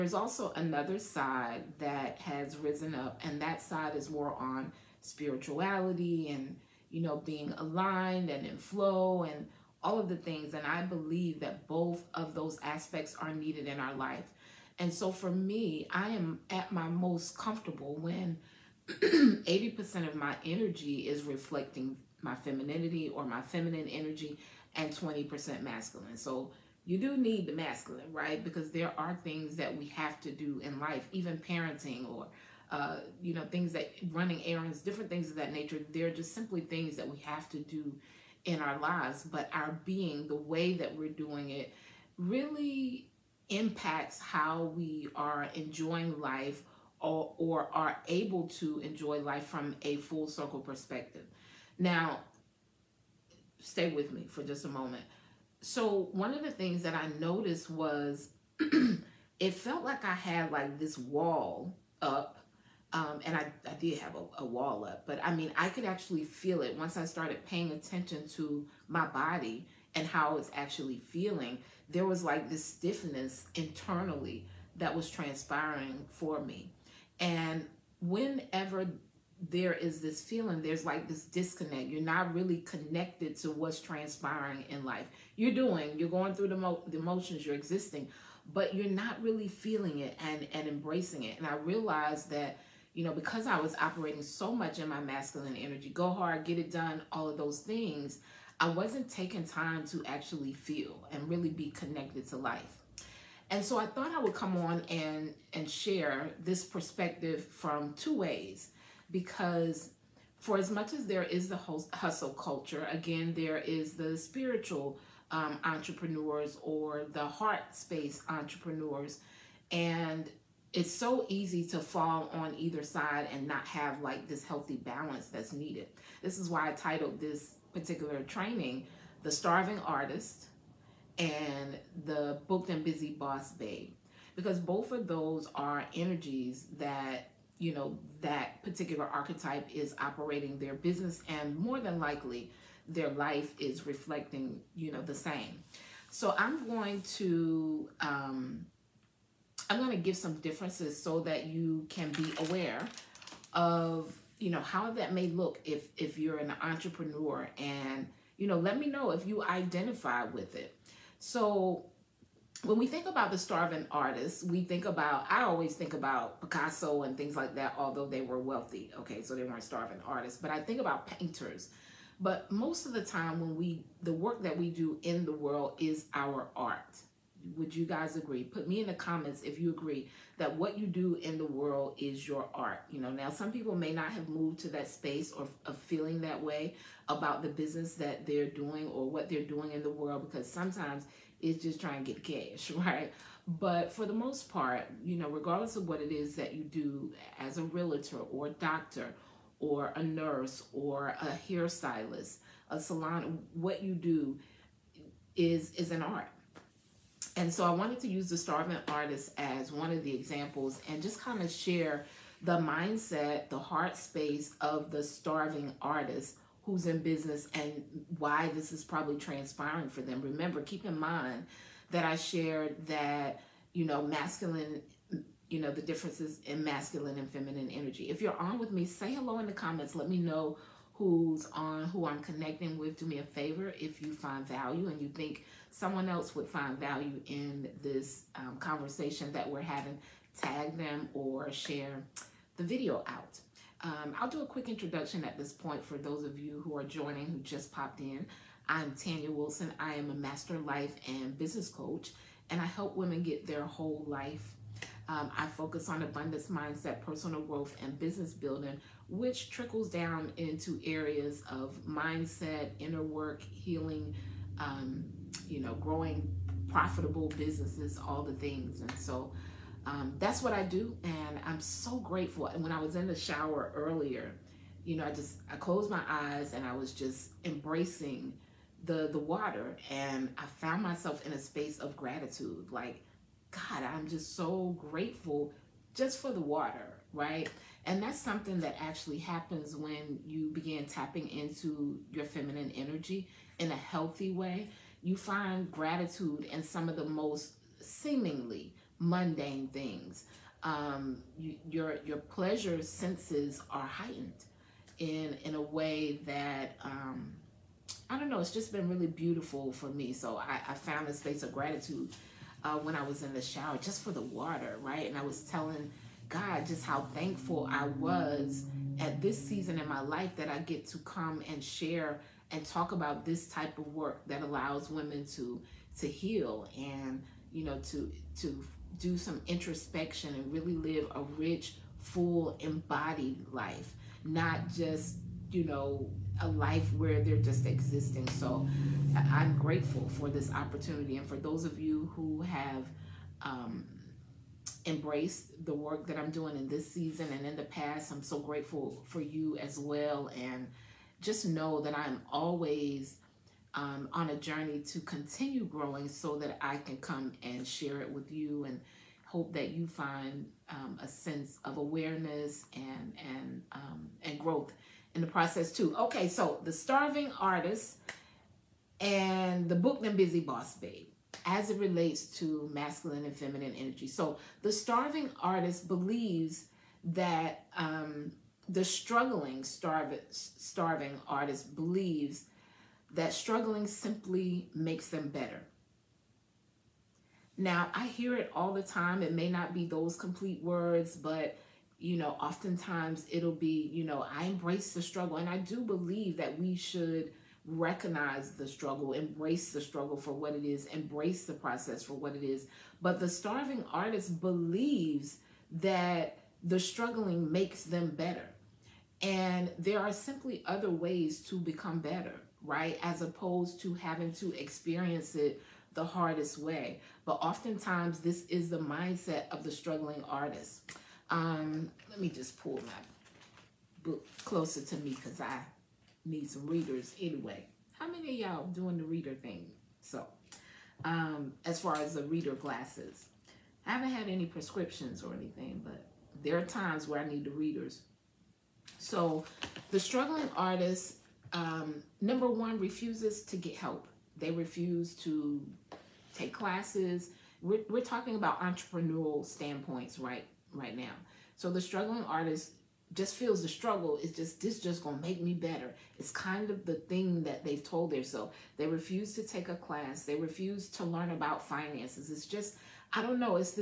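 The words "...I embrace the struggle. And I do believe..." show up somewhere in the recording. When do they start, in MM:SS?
06:34.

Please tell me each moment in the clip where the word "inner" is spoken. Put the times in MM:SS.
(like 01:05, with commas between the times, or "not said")
04:22.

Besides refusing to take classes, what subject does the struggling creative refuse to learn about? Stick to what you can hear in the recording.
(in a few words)
Finances.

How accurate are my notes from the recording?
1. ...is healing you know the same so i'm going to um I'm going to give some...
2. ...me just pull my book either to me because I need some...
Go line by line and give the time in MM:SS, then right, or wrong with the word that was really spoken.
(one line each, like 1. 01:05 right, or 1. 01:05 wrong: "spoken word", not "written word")
1. 02:23 wrong: "reflecting", not "healing"
2. 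07:02 wrong: "closer", not "either".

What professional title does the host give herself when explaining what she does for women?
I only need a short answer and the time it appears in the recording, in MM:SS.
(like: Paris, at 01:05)
Master life and business coach, at 04:10.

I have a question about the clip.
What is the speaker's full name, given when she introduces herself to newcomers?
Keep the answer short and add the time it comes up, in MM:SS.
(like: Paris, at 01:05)
Tanya Wilson, at 04:08.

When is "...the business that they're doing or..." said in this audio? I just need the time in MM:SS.
03:07.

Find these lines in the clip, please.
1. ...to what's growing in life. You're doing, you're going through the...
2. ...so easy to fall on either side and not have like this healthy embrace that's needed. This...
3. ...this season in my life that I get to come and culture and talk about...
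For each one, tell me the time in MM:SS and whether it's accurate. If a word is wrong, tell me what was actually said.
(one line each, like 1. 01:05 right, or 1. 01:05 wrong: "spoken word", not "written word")
1. 01:23 wrong: "transpiring", not "growing"
2. 02:00 wrong: "balance", not "embrace"
3. 05:19 wrong: "share", not "culture".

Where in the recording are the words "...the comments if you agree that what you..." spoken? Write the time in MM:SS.
02:58.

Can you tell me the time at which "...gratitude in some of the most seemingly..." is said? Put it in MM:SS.
04:55.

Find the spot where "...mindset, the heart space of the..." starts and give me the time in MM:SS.
03:32.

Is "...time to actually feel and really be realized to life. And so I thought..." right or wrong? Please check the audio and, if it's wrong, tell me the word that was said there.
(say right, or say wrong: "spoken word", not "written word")
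wrong: "connected", not "realized".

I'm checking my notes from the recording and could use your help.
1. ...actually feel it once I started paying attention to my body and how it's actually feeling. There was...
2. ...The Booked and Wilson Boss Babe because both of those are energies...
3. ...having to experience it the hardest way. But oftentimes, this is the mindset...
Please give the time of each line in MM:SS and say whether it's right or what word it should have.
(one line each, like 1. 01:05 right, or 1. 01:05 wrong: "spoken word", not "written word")
1. 01:05 right
2. 02:12 wrong: "Busy", not "Wilson"
3. 06:53 right.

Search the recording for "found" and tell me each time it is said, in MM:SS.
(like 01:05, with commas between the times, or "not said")
04:40, 05:10.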